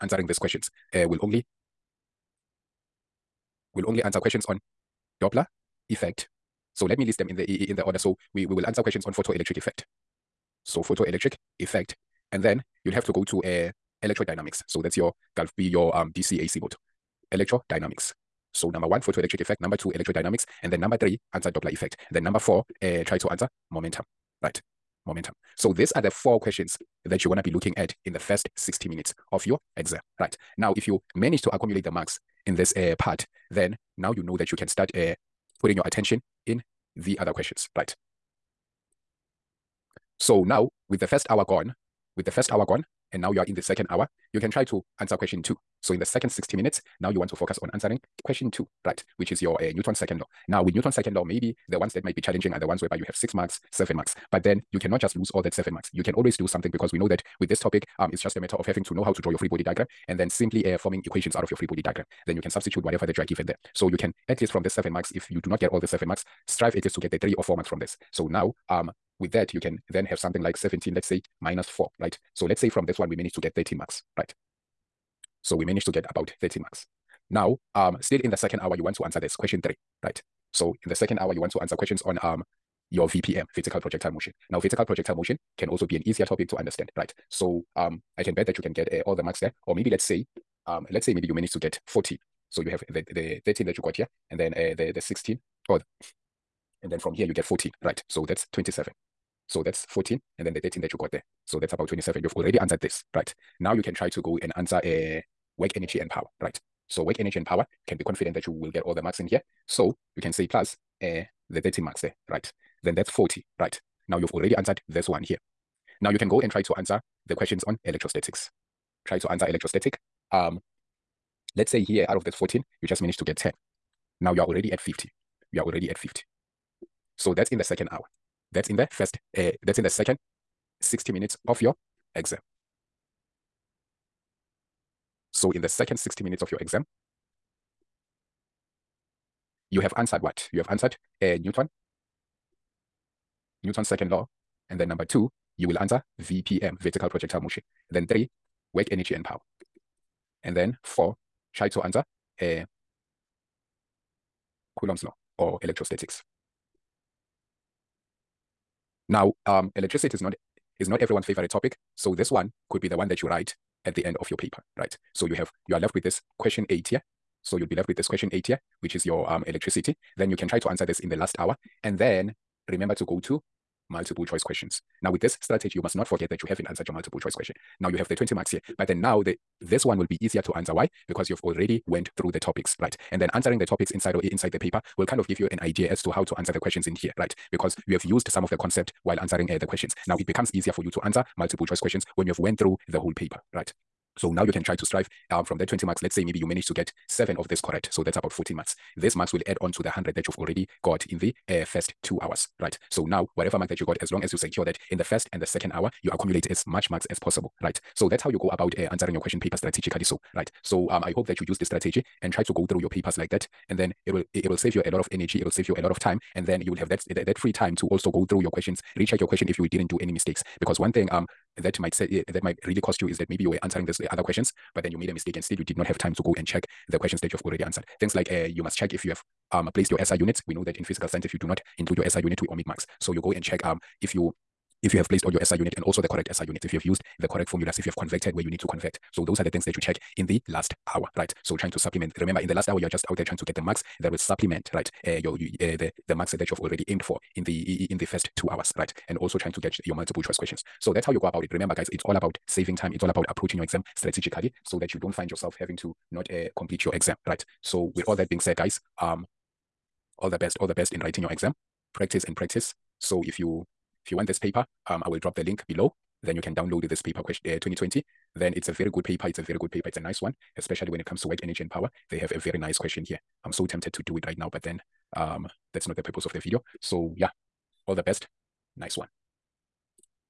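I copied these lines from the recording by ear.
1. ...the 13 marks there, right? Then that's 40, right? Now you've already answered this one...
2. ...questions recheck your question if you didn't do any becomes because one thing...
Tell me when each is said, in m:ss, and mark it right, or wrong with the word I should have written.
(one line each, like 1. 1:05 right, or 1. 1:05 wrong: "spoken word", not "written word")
1. 1:51 right
2. 3:38 wrong: "mistakes", not "becomes".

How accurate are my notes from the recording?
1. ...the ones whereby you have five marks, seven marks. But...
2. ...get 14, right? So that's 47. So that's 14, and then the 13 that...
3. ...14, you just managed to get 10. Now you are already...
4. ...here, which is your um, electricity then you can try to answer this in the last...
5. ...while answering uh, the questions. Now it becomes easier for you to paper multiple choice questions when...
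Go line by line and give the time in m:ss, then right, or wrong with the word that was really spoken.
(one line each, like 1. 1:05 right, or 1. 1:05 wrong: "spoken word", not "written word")
1. 0:52 wrong: "six", not "five"
2. 1:37 wrong: "27", not "47"
3. 2:02 right
4. 2:48 right
5. 3:09 wrong: "answer", not "paper".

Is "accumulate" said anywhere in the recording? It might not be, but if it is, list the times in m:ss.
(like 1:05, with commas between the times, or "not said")
0:31, 3:26.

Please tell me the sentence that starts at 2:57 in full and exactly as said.
Now you have the 20 marks here, but then now the this one will be easier to answer.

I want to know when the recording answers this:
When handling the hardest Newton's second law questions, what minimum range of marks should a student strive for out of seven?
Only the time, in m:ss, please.
1:07.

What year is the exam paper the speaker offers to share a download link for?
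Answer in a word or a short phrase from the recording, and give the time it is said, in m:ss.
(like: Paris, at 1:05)
2020, at 4:27.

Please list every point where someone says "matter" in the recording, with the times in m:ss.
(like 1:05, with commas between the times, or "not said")
0:58.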